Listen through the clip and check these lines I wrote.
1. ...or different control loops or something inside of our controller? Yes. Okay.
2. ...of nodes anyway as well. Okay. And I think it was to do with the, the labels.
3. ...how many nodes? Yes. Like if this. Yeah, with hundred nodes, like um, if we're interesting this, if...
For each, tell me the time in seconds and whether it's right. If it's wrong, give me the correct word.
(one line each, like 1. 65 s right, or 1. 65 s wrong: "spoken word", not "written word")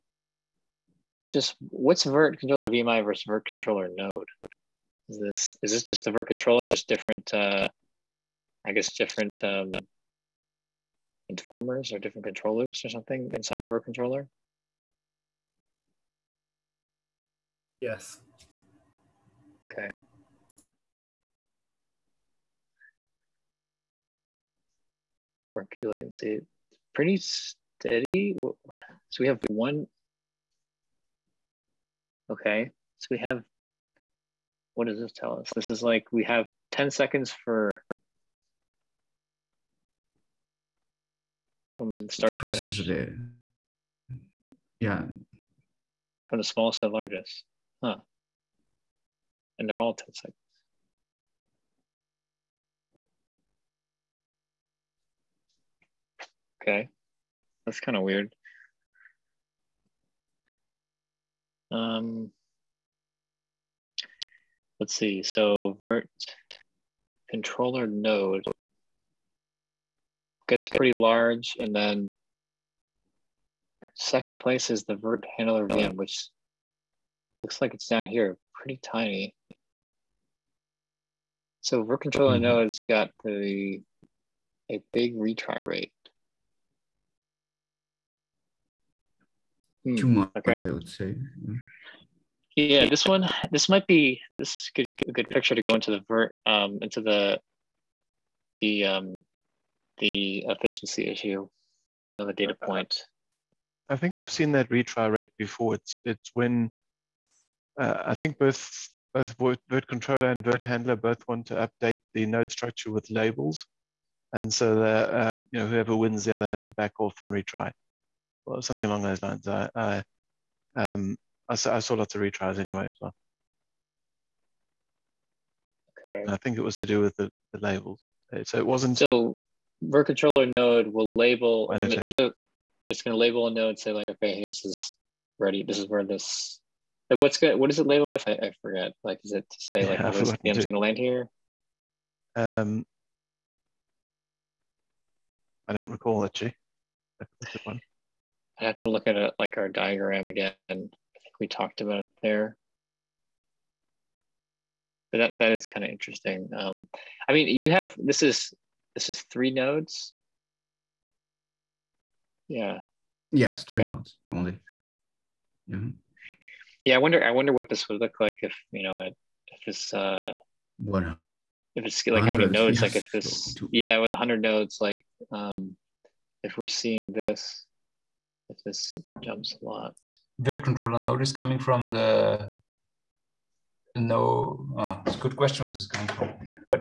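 1. 11 s right
2. 122 s wrong: "retries", not "nodes"
3. 172 s wrong: "seeing", not "interesting".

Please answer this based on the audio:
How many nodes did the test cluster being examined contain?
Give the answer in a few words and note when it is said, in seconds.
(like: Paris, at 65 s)
3, at 163 s.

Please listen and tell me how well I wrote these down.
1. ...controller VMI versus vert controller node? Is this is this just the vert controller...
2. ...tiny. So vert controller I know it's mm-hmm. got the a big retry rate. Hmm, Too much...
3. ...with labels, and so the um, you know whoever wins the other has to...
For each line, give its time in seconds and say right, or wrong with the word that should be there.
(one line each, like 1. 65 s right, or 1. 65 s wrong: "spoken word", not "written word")
1. 2 s right
2. 78 s right
3. 112 s right.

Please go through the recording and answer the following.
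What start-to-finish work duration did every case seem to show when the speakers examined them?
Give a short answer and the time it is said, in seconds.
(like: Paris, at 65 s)
10 seconds, at 36 s.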